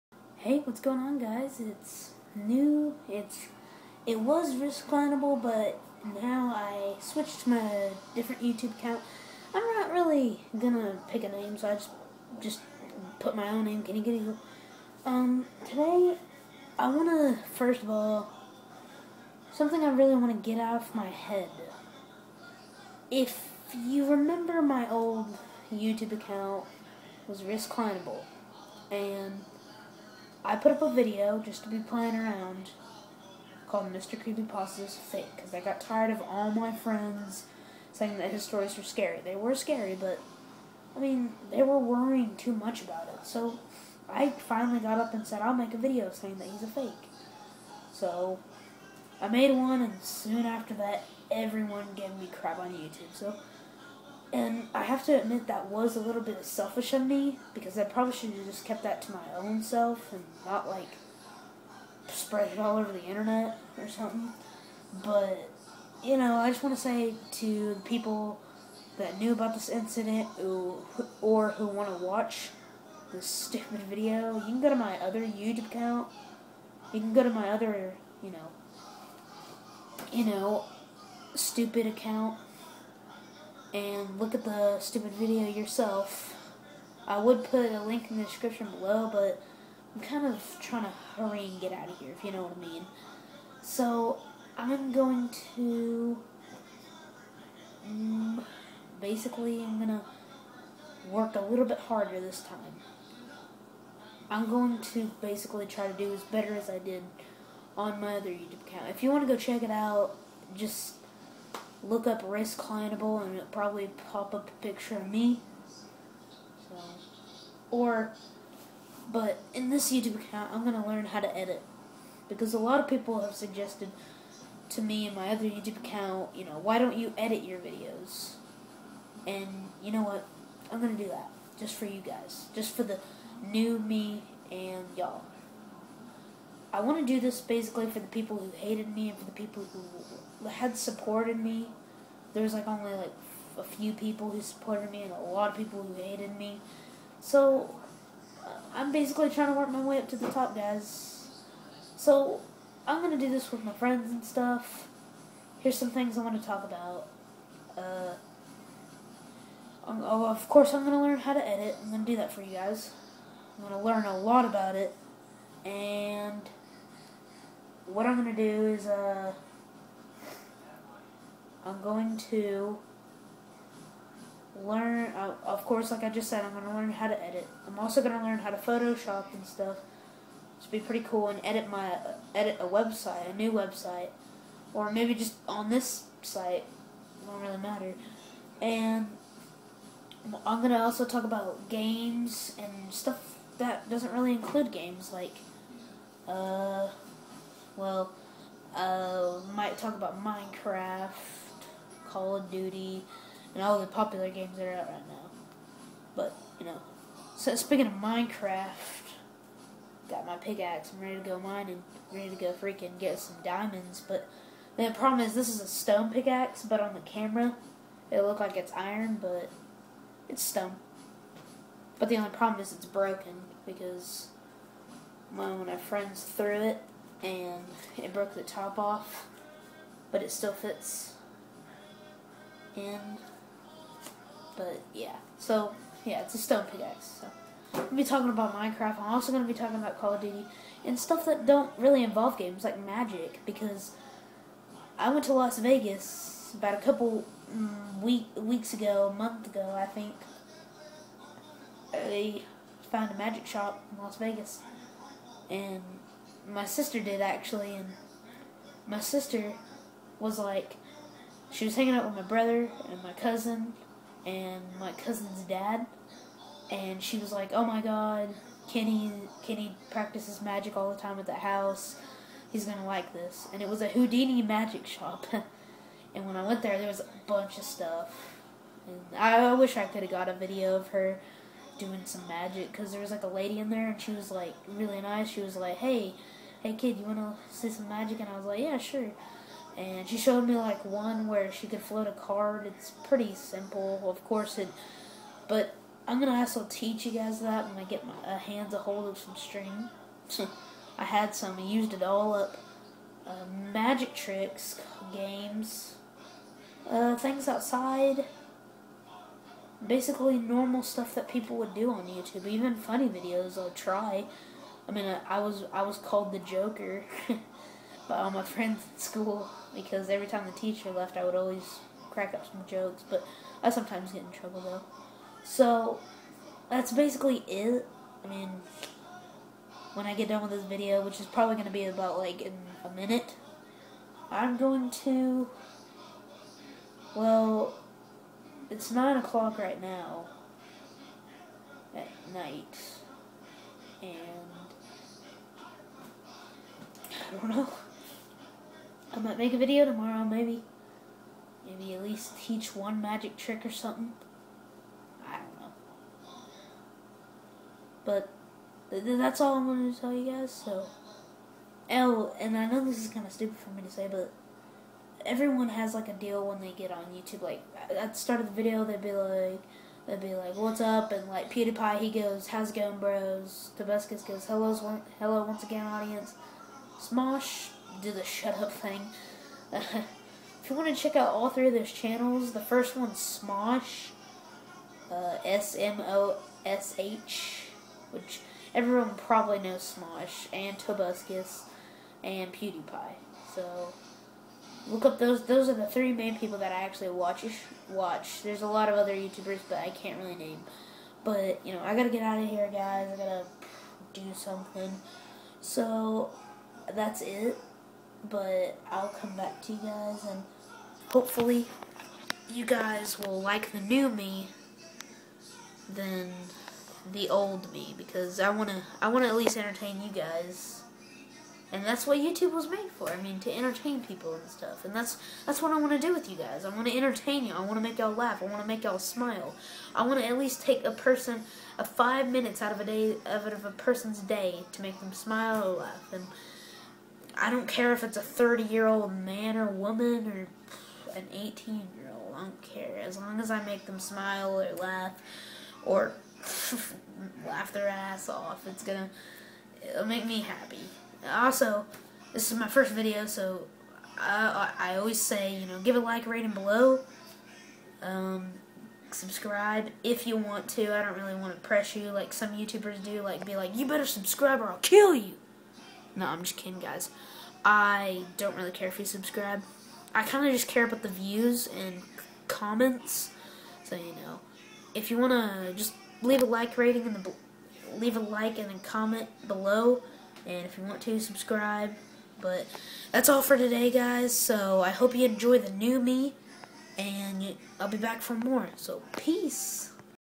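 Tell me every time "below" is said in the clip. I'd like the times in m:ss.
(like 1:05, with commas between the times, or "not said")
1:28, 7:36, 7:59.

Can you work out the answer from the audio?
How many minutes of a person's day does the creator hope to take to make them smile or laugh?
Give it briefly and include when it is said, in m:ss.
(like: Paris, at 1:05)
5, at 7:11.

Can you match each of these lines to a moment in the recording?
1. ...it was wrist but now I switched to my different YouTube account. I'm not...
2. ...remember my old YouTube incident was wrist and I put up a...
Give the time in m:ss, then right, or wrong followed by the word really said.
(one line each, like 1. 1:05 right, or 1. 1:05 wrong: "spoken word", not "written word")
1. 0:04 right
2. 0:24 wrong: "account", not "incident".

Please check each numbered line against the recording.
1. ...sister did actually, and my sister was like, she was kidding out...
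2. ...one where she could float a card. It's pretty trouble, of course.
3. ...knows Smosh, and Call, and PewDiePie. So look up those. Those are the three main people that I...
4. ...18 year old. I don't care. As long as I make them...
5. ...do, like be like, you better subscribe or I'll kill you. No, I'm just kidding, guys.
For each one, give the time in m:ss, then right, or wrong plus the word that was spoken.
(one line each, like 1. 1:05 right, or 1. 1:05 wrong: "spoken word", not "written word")
1. 4:16 wrong: "hanging", not "kidding"
2. 4:50 wrong: "simple", not "trouble"
3. 6:29 wrong: "Tobuscus", not "Call"
4. 7:21 right
5. 7:43 right.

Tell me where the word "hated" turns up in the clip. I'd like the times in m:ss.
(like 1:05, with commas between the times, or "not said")
2:18, 2:26.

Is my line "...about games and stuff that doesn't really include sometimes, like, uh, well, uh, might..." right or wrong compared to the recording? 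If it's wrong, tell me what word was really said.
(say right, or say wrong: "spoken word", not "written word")
wrong: "games", not "sometimes".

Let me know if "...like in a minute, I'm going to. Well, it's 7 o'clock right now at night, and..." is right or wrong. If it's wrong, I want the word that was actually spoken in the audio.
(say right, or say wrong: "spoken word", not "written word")
wrong: "9", not "7".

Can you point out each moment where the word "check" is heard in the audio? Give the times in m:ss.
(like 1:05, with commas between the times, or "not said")
1:49, 6:20.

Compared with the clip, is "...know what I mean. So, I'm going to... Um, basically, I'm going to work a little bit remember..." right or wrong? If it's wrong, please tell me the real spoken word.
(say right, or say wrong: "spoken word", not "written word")
wrong: "harder", not "remember".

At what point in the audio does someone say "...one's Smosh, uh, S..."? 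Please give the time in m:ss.
6:22.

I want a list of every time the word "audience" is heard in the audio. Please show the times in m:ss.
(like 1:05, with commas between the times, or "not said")
6:15.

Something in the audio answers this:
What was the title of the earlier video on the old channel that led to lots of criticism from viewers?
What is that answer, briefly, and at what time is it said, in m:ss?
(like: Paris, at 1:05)
Mr. Creepy is Fake, at 0:33.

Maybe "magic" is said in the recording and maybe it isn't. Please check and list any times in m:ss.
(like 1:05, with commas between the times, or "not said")
4:02, 4:13, 4:30, 4:34, 4:42, 4:47, 5:03, 5:53.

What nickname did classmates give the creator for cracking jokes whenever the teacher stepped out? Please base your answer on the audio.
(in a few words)
The Joker.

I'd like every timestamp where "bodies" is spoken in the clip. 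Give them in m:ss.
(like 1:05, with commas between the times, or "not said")
not said.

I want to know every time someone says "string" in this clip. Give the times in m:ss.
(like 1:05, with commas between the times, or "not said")
4:59.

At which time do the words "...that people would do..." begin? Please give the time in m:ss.
5:11.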